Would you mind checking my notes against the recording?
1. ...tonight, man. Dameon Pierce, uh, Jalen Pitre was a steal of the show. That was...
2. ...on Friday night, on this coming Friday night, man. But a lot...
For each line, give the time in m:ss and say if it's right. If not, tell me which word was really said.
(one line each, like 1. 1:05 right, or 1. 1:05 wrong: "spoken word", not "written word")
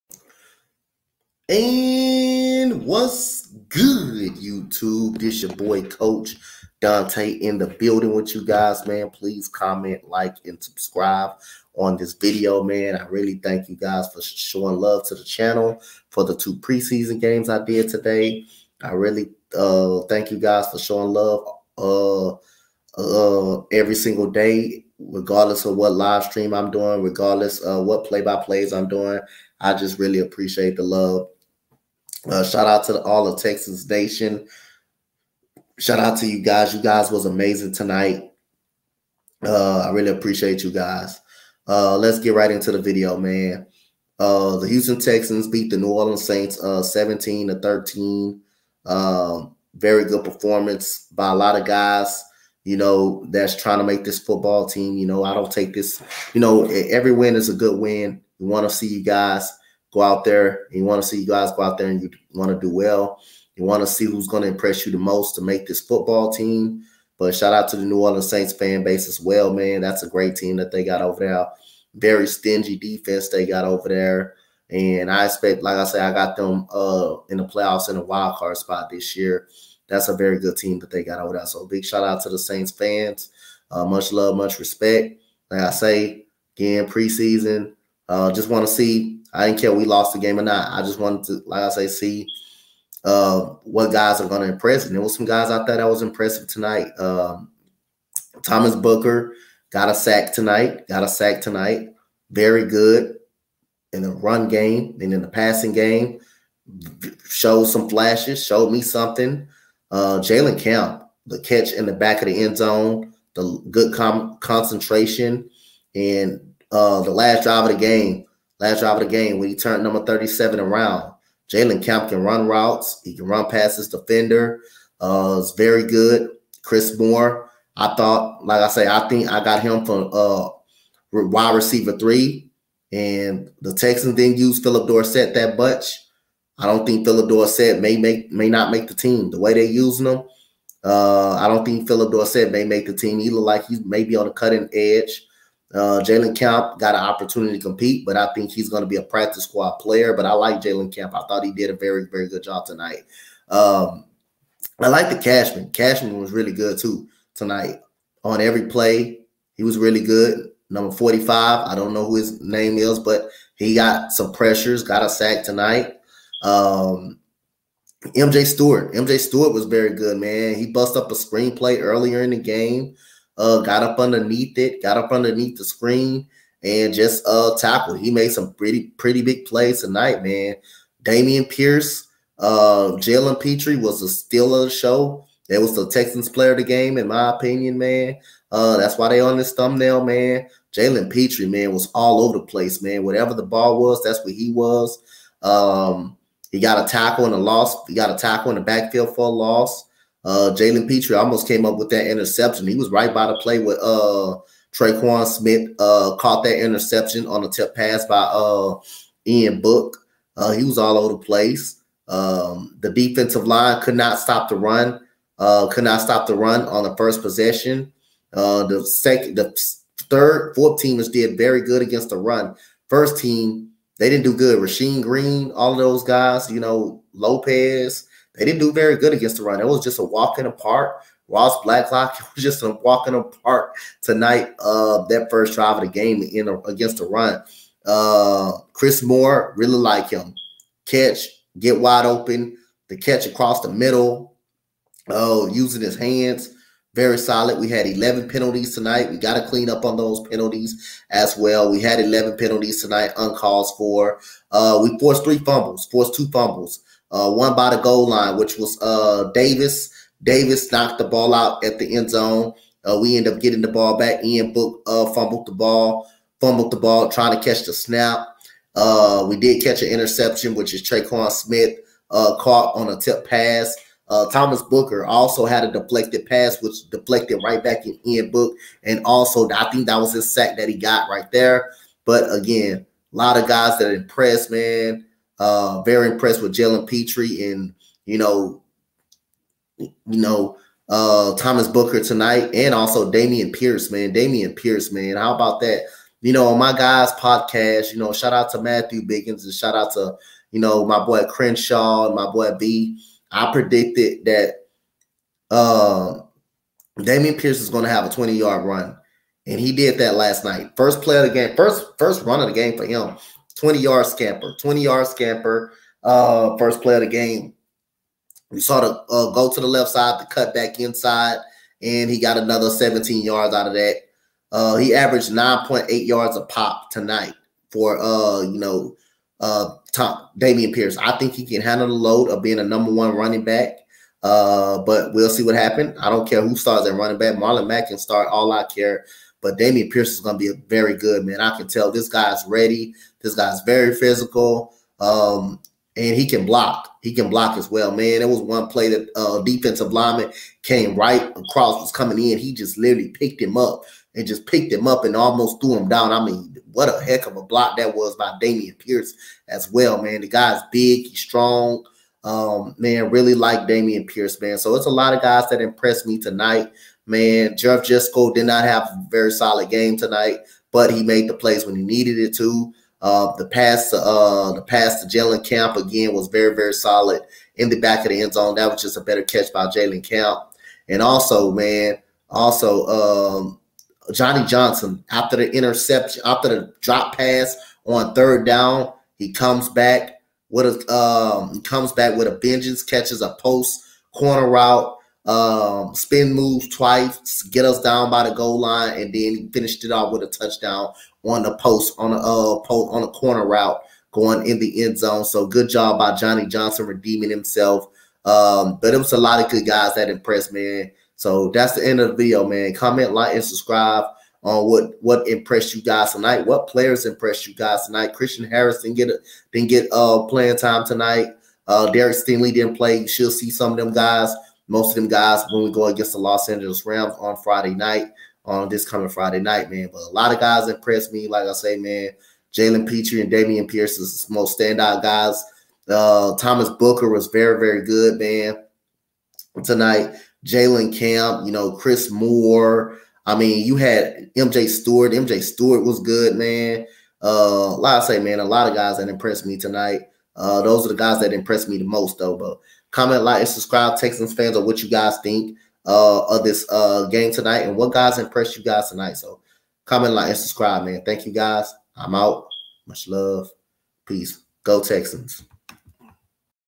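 1. 2:59 right
2. 7:07 right.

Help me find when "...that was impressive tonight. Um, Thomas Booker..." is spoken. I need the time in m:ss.
1:35.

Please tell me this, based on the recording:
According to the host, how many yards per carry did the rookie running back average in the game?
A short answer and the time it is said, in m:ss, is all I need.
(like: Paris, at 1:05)
9.8, at 5:25.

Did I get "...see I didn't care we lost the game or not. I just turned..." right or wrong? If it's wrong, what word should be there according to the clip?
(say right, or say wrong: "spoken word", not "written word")
wrong: "wanted", not "turned".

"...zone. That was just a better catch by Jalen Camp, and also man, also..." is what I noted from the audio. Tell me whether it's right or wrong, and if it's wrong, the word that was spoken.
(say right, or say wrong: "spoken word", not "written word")
right.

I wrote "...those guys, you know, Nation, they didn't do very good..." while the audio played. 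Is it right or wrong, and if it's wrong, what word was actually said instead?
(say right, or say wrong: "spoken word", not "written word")
wrong: "Lopez", not "Nation".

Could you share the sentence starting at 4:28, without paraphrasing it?
Uh, we did catch an interception, which is Traquan Smith uh, caught on a tip pass.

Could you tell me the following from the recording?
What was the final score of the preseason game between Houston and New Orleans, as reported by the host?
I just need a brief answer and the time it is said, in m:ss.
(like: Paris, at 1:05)
17-13, at 0:46.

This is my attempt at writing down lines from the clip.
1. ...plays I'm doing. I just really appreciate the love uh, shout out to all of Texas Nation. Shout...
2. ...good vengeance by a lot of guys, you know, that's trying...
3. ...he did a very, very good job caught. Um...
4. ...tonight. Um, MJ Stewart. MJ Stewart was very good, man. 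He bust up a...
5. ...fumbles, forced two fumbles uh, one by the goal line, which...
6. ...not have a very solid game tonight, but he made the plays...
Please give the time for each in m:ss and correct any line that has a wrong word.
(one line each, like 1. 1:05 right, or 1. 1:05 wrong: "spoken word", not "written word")
1. 0:28 right
2. 0:50 wrong: "performance", not "vengeance"
3. 2:31 wrong: "tonight", not "caught"
4. 2:45 right
5. 4:15 right
6. 6:08 right.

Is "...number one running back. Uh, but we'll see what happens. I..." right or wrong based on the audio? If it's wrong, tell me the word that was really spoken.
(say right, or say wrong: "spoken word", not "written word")
right.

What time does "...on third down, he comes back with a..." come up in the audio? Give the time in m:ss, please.
6:27.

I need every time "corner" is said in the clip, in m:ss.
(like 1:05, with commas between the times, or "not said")
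6:34, 6:43.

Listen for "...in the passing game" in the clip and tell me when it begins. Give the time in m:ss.
1:45.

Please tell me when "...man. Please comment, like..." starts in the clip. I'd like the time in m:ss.
0:08.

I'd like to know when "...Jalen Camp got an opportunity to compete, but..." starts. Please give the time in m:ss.
2:26.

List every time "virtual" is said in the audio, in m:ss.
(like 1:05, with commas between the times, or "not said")
not said.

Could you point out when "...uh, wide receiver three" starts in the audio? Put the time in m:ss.
2:10.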